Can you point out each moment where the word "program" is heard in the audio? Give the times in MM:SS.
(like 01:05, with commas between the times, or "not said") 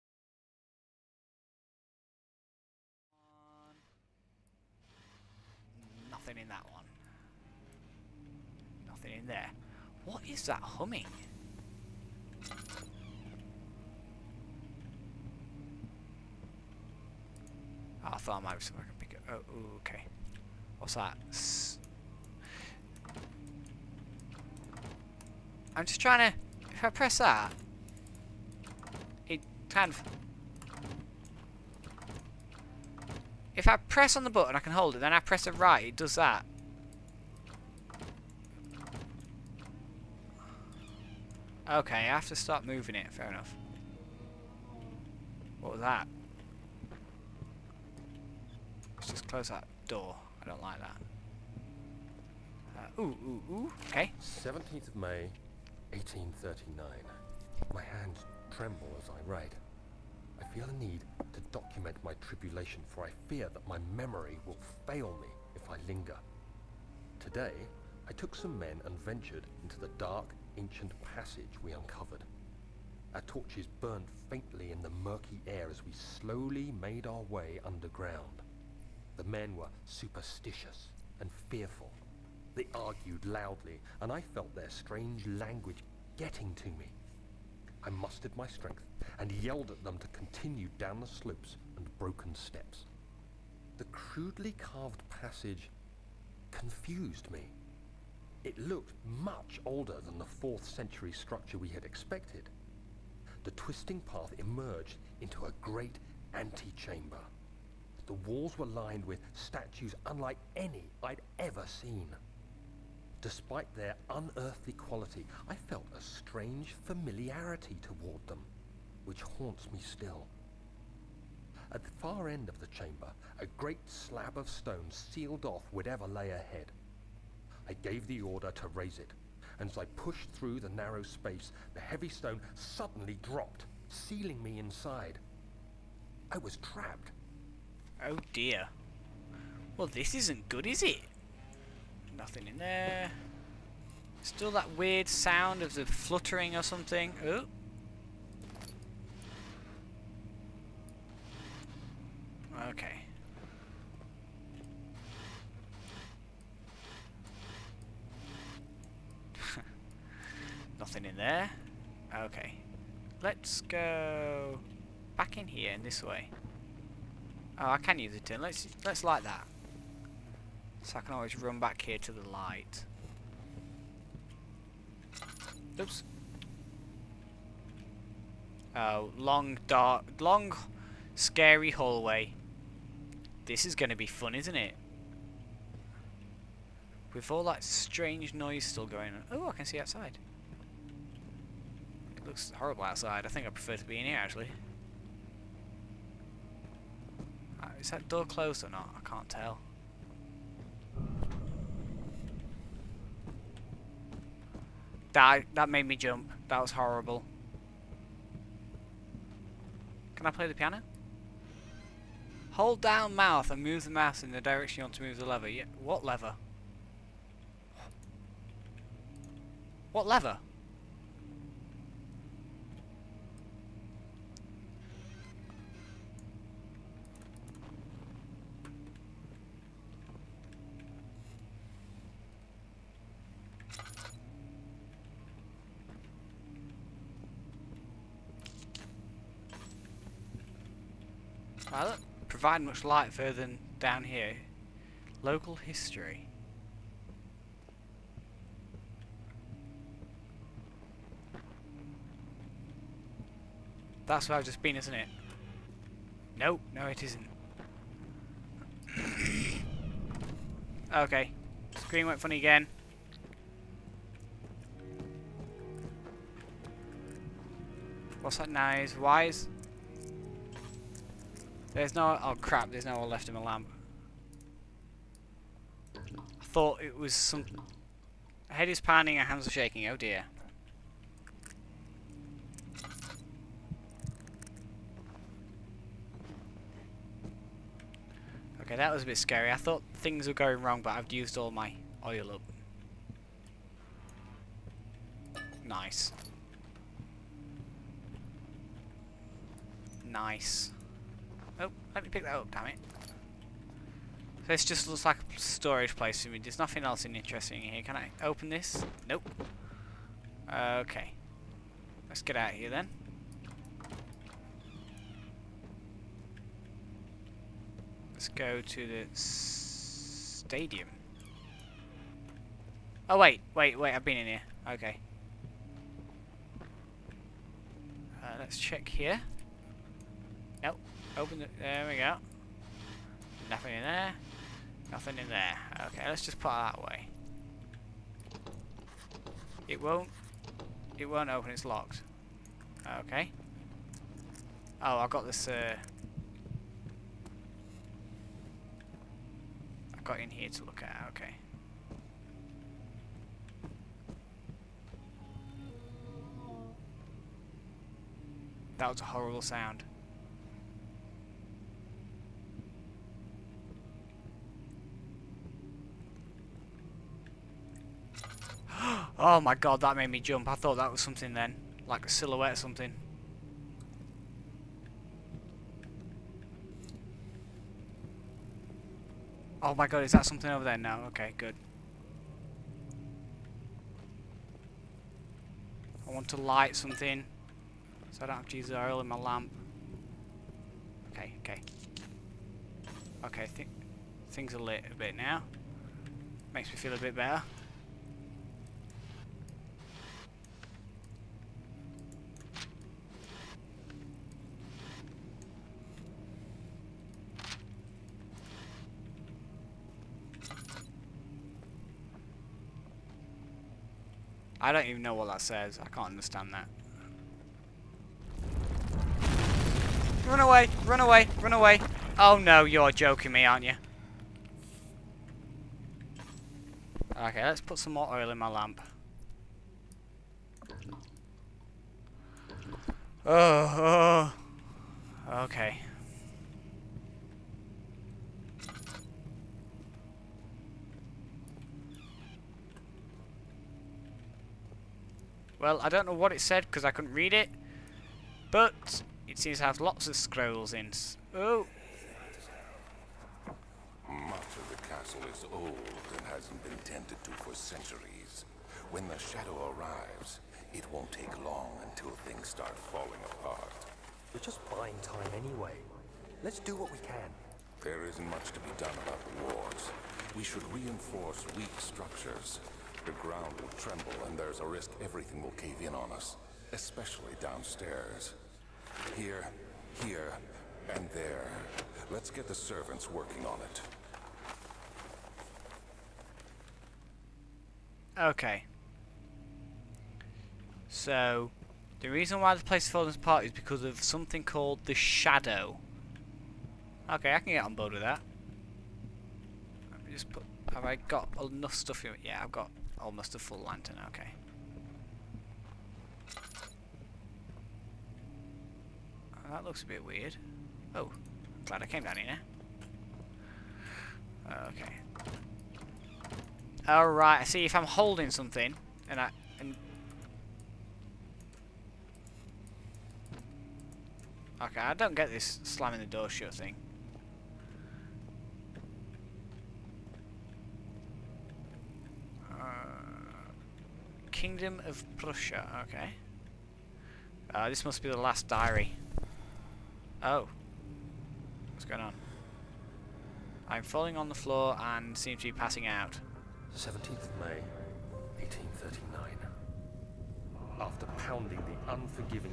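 not said.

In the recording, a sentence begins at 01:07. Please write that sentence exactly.
Today, I took some men and ventured into the dark, ancient passage we uncovered.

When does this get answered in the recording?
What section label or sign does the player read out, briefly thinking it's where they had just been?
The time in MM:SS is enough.
04:05.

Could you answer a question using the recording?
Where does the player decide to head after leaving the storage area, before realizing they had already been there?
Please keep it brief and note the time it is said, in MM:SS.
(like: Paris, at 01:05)
the stadium, at 05:19.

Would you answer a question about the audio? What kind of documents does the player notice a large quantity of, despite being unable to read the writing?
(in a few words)
scrolls.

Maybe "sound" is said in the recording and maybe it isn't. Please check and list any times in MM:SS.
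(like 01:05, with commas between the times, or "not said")
02:25, 05:59.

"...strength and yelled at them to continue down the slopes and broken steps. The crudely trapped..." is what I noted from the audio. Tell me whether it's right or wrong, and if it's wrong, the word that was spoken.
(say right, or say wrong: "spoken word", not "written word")
wrong: "carved", not "trapped".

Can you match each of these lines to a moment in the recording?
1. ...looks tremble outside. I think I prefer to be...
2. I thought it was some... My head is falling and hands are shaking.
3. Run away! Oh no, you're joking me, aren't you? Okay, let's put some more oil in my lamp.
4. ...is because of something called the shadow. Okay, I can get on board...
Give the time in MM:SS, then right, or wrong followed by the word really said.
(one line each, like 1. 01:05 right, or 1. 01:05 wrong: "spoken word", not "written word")
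1. 03:12 wrong: "horrible", not "tremble"
2. 04:35 wrong: "pounding", not "falling"
3. 07:01 right
4. 08:13 right.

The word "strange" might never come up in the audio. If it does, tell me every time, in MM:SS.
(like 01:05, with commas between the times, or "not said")
01:24, 01:56, 03:07.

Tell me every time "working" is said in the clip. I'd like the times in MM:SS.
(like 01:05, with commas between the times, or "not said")
08:03.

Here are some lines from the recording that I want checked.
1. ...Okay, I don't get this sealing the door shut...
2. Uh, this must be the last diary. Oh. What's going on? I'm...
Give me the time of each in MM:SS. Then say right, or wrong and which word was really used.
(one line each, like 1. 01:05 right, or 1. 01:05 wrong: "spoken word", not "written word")
1. 08:44 wrong: "slamming", not "sealing"
2. 08:57 right.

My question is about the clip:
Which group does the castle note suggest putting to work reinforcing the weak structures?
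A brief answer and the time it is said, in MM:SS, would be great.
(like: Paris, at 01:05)
servants, at 08:02.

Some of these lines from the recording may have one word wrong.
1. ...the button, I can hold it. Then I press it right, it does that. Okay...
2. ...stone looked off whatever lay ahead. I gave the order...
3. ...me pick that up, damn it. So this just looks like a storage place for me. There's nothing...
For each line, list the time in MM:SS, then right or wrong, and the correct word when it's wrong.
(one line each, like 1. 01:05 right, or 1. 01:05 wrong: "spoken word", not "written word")
1. 00:34 right
2. 02:04 wrong: "sealed", not "looked"
3. 05:02 right.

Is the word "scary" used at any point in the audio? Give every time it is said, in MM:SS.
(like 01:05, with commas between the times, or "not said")
03:01, 04:49.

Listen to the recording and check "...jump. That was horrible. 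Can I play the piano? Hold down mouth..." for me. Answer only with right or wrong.
right.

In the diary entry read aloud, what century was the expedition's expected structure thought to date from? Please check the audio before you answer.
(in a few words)
4th century.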